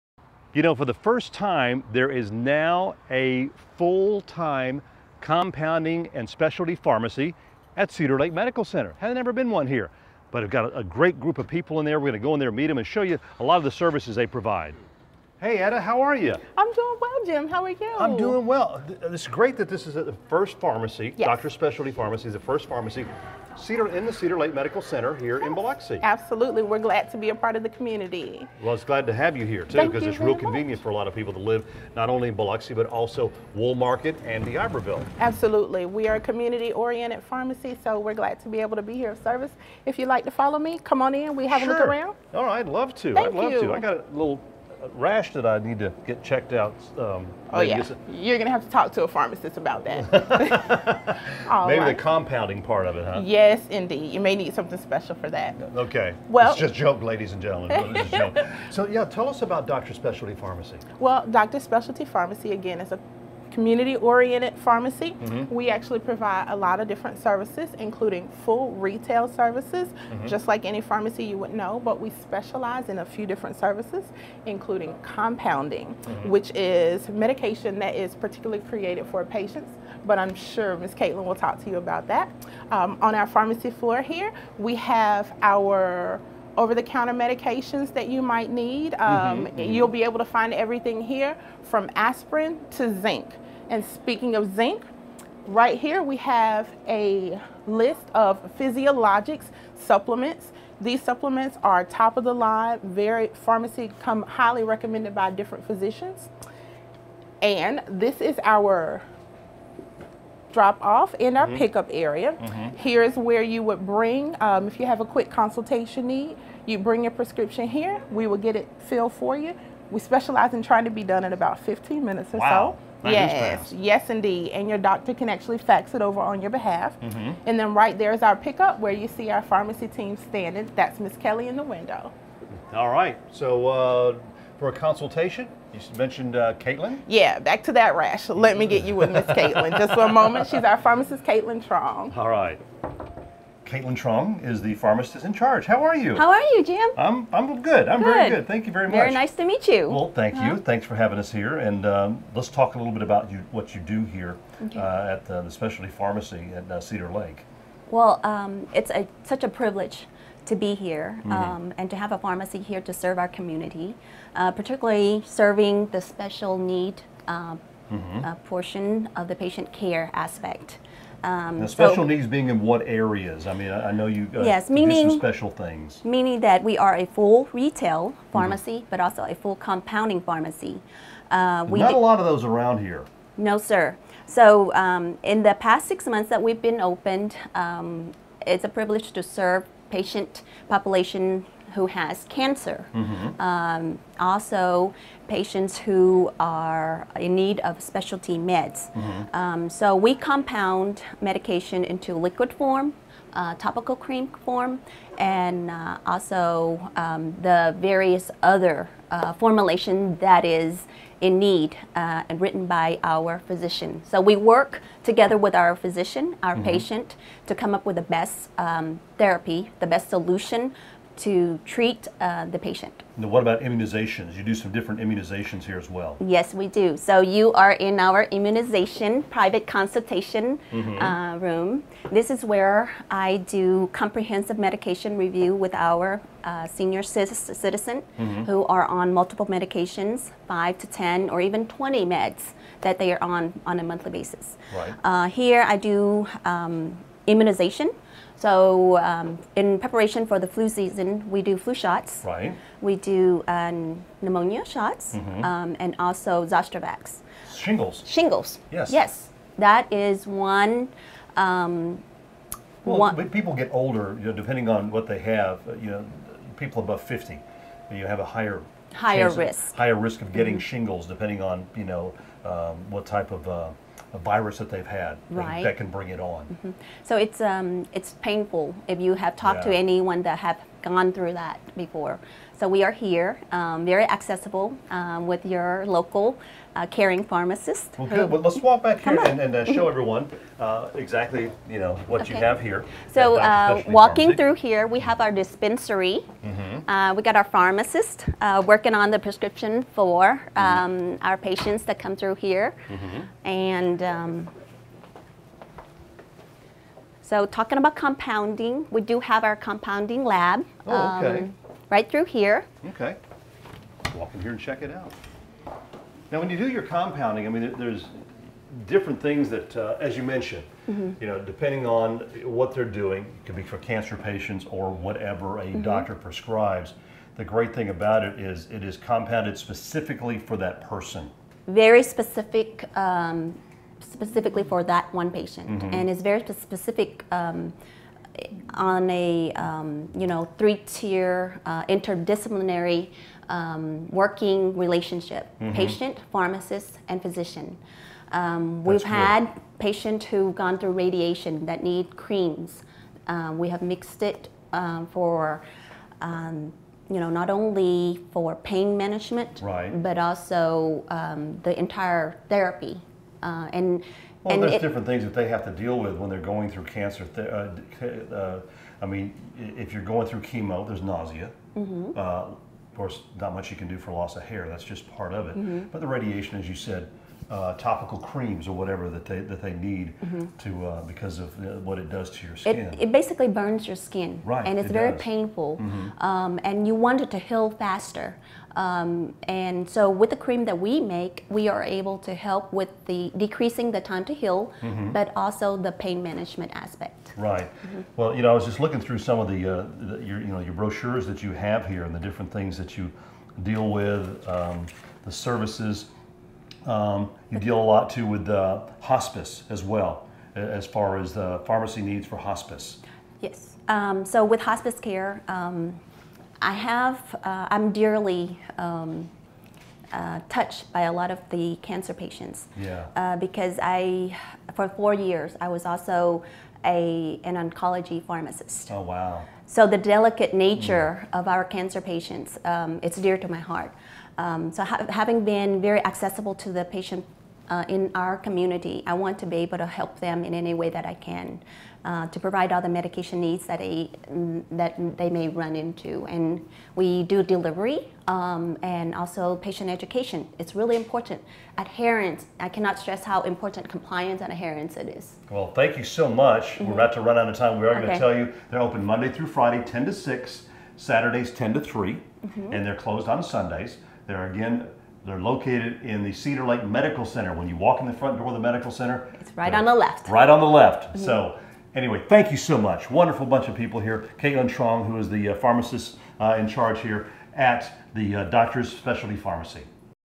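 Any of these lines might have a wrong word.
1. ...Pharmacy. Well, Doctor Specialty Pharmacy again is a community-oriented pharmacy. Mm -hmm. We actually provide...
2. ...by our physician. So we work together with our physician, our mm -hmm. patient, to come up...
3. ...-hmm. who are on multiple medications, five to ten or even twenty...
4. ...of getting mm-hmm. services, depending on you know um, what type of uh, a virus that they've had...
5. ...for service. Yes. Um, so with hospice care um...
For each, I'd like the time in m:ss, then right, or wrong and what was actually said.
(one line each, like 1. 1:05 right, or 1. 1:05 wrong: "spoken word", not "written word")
1. 1:00 right
2. 3:32 right
3. 3:58 right
4. 4:30 wrong: "shingles", not "services"
5. 6:52 wrong: "hospice", not "service".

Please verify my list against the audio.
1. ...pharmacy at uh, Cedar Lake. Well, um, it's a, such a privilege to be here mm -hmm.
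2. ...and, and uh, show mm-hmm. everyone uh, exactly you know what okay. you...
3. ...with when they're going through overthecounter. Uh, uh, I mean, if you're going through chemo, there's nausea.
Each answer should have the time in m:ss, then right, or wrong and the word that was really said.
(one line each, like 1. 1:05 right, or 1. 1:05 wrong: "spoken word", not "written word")
1. 2:35 right
2. 4:49 right
3. 6:05 wrong: "cancer", not "overthecounter".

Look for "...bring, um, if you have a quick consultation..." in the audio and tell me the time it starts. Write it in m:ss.
1:53.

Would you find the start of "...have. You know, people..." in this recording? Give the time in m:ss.
4:25.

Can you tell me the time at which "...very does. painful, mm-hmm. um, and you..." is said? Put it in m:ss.
6:24.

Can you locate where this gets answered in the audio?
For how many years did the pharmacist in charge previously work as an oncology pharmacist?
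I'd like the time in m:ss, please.
7:04.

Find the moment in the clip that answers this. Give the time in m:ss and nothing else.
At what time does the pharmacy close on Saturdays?
7:40.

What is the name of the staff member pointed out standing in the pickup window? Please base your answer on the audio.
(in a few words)
Kelly.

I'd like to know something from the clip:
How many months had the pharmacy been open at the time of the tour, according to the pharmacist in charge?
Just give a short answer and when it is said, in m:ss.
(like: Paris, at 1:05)
6, at 3:05.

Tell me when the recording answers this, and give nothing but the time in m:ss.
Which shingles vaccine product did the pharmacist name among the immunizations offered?
4:16.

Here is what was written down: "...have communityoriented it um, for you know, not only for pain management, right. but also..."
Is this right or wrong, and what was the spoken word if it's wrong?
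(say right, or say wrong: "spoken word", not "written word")
wrong: "mixed", not "communityoriented".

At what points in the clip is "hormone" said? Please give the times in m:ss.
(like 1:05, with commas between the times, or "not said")
not said.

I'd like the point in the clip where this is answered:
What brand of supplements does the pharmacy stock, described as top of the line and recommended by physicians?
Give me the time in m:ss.
1:38.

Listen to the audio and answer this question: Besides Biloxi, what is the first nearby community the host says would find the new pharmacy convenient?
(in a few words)
Woolmarket.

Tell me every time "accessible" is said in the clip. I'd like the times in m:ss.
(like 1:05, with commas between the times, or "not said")
4:44, 7:16.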